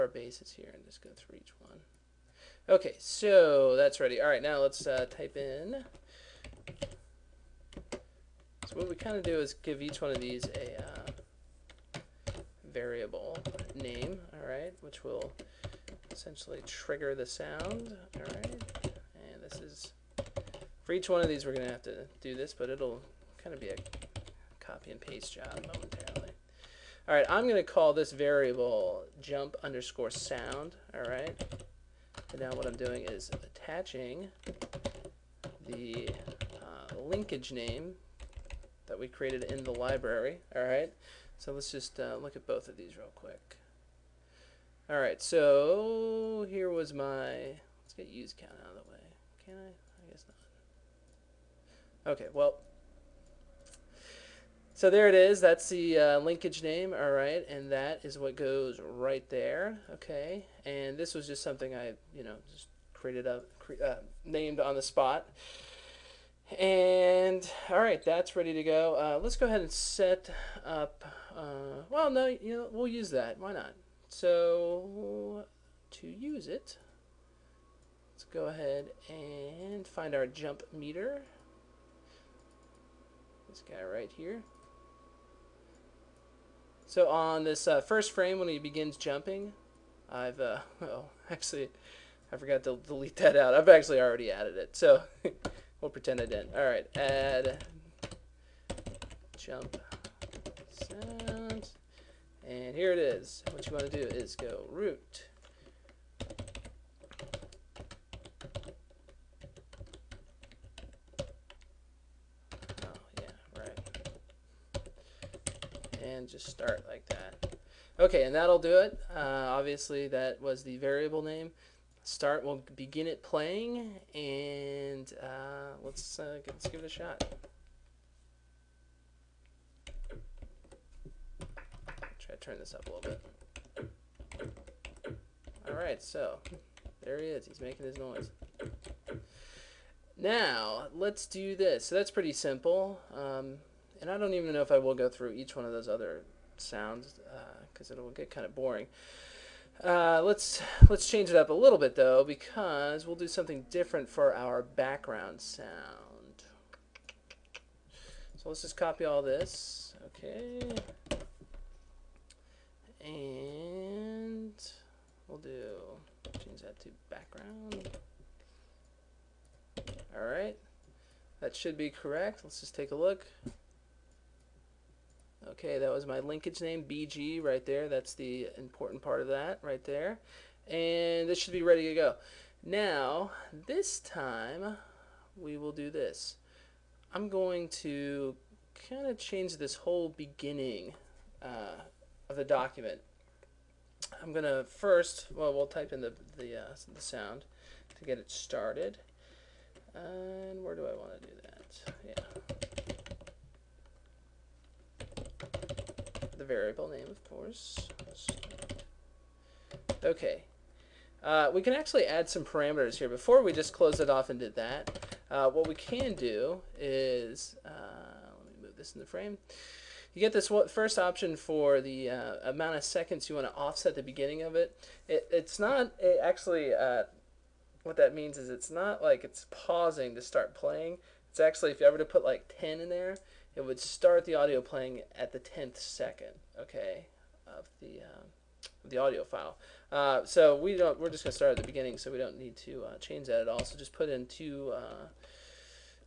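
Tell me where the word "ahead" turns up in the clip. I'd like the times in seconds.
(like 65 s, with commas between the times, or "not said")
69 s, 78 s.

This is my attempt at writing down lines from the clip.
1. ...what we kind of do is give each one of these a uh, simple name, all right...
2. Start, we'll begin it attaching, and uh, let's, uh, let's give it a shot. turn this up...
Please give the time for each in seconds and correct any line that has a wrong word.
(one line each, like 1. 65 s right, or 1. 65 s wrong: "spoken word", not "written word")
1. 8 s wrong: "variable", not "simple"
2. 122 s wrong: "playing", not "attaching".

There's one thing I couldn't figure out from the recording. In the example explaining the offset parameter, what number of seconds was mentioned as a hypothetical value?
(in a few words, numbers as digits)
10.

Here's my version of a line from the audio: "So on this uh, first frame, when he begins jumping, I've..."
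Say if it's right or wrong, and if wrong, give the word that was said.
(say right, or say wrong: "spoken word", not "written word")
right.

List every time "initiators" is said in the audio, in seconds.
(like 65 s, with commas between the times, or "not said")
not said.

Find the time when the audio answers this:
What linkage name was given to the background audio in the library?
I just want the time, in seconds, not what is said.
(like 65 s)
176 s.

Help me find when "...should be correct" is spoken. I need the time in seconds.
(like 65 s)
171 s.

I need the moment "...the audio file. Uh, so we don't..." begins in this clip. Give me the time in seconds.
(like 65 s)
238 s.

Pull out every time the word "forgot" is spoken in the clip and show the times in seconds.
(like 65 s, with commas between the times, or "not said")
92 s.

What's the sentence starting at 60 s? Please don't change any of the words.
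And this was just something I, you know, just created up, cre uh, named on the spot.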